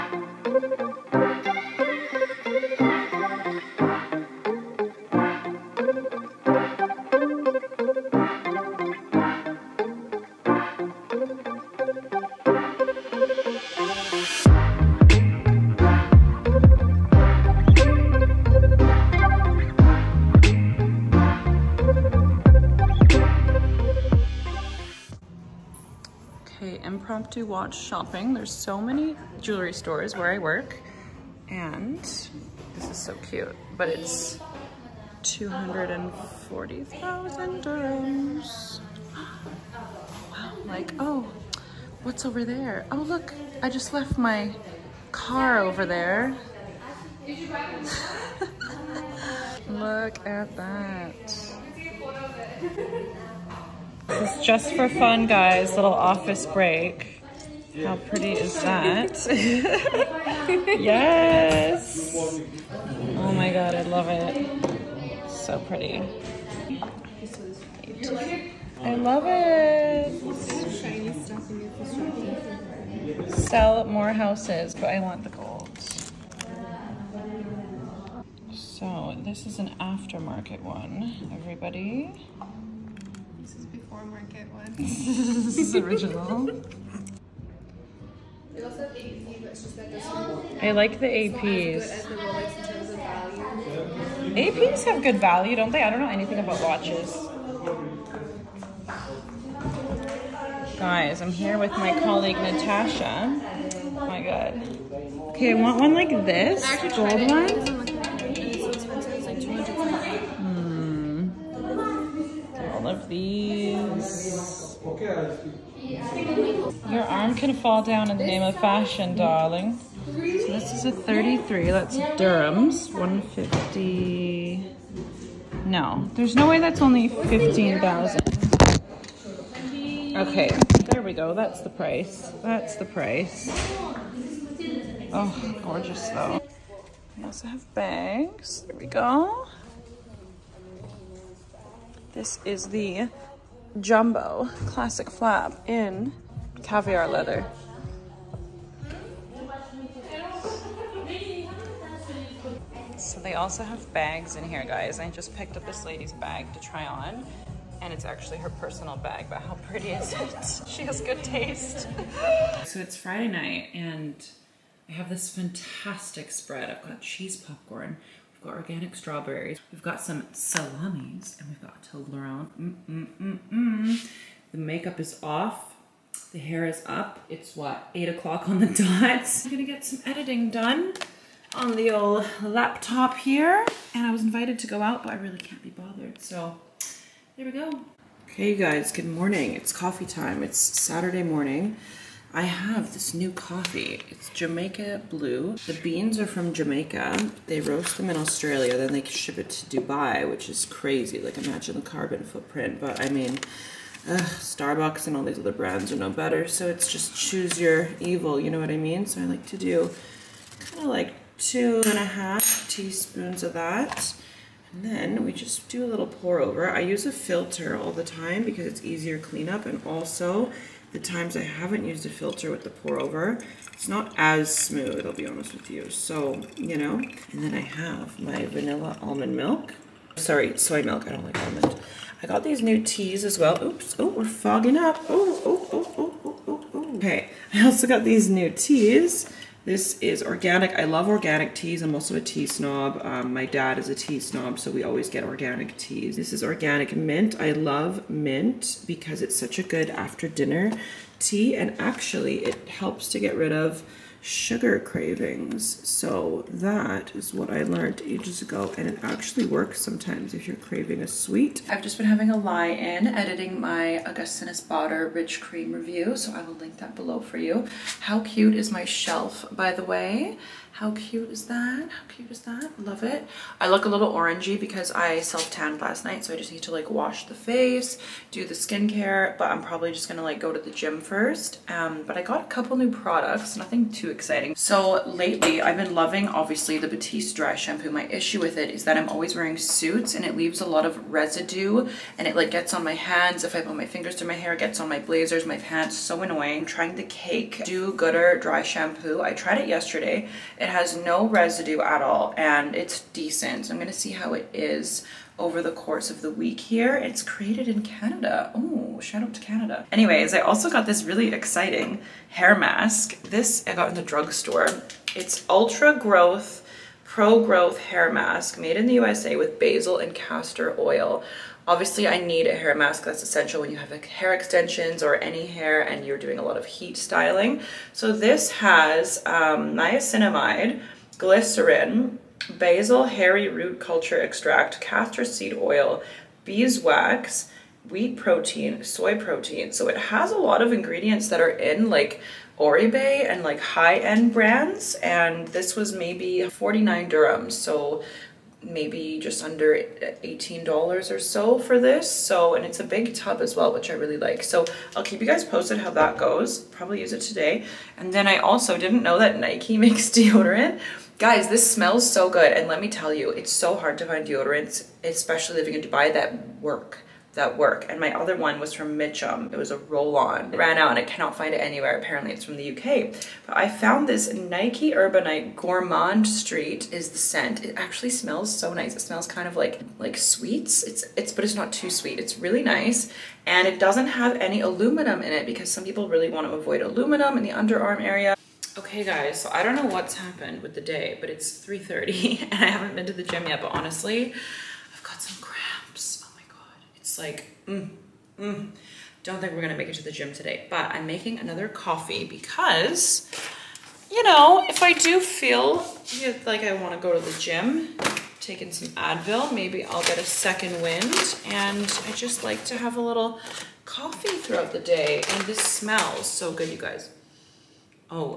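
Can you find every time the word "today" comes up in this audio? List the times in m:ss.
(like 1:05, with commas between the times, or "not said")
5:57, 6:40.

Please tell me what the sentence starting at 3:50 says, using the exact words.
Sorry, soy milk, I don't like almond.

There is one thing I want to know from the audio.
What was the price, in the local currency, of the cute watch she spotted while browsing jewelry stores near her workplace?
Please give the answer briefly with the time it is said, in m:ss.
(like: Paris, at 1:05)
240,000 dirhams, at 0:35.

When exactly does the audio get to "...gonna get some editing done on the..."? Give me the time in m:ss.
2:59.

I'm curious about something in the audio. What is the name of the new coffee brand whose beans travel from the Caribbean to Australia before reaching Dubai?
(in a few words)
Jamaica Blue.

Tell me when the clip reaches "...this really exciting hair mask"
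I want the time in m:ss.
5:10.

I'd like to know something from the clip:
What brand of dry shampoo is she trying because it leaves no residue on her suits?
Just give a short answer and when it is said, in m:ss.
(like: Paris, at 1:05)
Cake, at 4:57.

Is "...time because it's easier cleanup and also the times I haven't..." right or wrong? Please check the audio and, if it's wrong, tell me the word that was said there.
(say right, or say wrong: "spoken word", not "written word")
right.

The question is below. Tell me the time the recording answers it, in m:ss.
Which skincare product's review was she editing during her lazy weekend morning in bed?
4:24.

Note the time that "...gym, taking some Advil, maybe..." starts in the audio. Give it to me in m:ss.
6:47.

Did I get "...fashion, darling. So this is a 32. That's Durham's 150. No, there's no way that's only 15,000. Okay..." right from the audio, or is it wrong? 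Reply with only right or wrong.
wrong.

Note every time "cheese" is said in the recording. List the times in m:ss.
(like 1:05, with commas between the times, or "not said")
2:47.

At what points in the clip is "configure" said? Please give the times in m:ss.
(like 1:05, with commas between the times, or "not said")
not said.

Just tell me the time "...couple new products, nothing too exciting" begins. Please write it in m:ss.
4:42.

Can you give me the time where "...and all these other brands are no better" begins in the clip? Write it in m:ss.
3:25.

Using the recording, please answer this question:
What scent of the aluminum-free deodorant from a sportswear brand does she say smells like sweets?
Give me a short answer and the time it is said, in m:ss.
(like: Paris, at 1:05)
Urbanite Gourmand Street, at 6:14.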